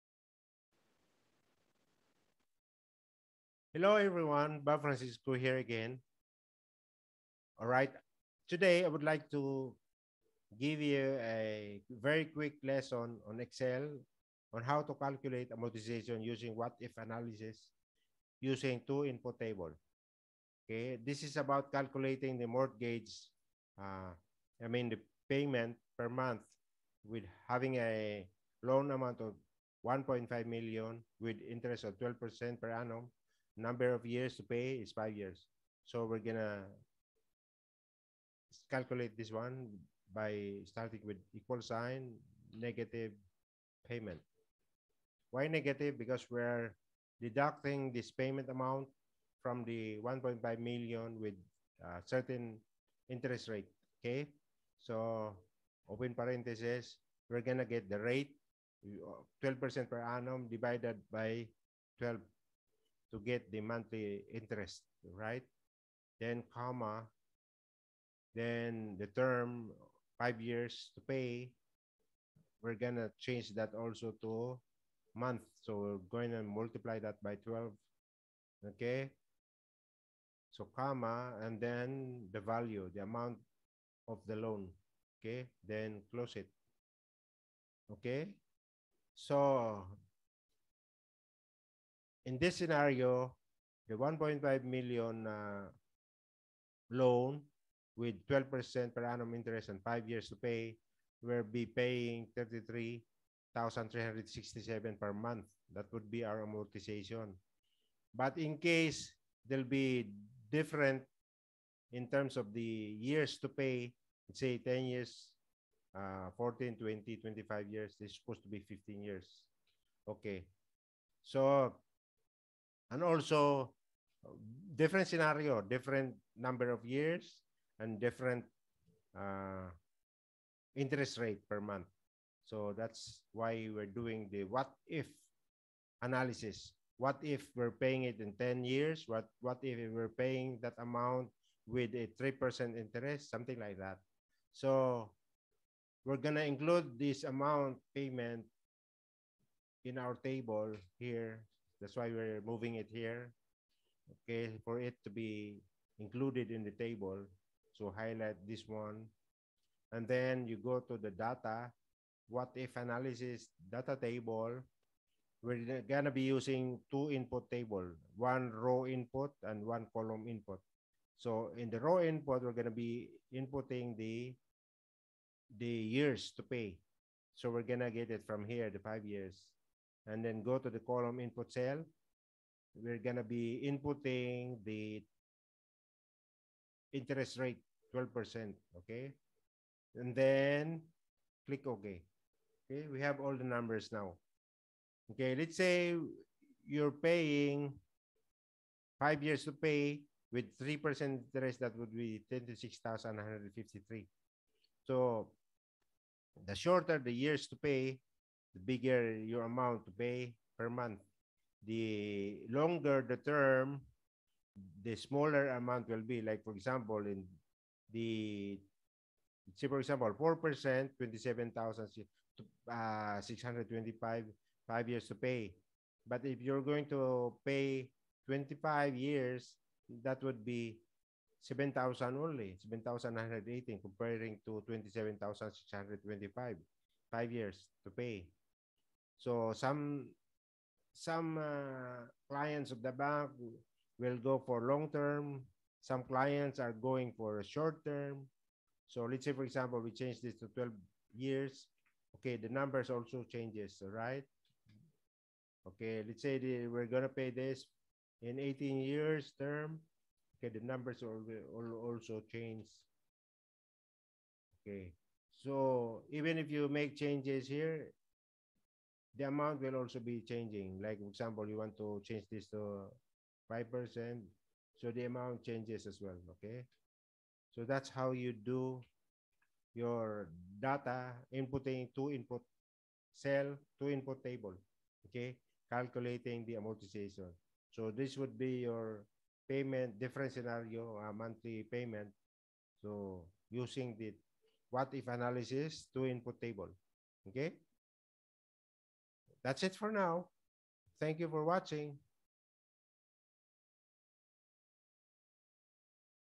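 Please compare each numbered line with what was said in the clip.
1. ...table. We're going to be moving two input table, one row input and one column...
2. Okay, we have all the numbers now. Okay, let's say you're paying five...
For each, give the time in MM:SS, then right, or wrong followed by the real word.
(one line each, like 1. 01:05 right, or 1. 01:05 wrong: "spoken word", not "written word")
1. 02:43 wrong: "using", not "moving"
2. 03:12 right.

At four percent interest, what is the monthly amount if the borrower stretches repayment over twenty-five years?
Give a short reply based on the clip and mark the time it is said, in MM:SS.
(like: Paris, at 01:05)
7,918, at 03:52.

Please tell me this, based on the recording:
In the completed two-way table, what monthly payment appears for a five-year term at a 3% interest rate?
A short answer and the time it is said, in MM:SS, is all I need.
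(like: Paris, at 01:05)
26,153, at 03:22.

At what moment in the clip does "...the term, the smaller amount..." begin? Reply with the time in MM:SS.
03:33.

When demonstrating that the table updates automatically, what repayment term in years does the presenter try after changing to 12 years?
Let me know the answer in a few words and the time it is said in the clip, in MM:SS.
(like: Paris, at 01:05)
18 years, at 04:18.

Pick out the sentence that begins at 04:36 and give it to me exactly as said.
Okay, so that's how you do your data inputting to input cell two input table.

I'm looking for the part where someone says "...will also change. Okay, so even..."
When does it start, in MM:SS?
04:21.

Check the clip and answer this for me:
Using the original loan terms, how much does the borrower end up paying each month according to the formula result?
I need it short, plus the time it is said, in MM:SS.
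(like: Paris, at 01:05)
33,367, at 01:42.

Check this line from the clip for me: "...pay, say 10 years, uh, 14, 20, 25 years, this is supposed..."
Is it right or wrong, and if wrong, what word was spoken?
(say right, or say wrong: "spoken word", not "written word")
right.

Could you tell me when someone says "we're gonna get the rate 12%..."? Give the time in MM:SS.
00:57.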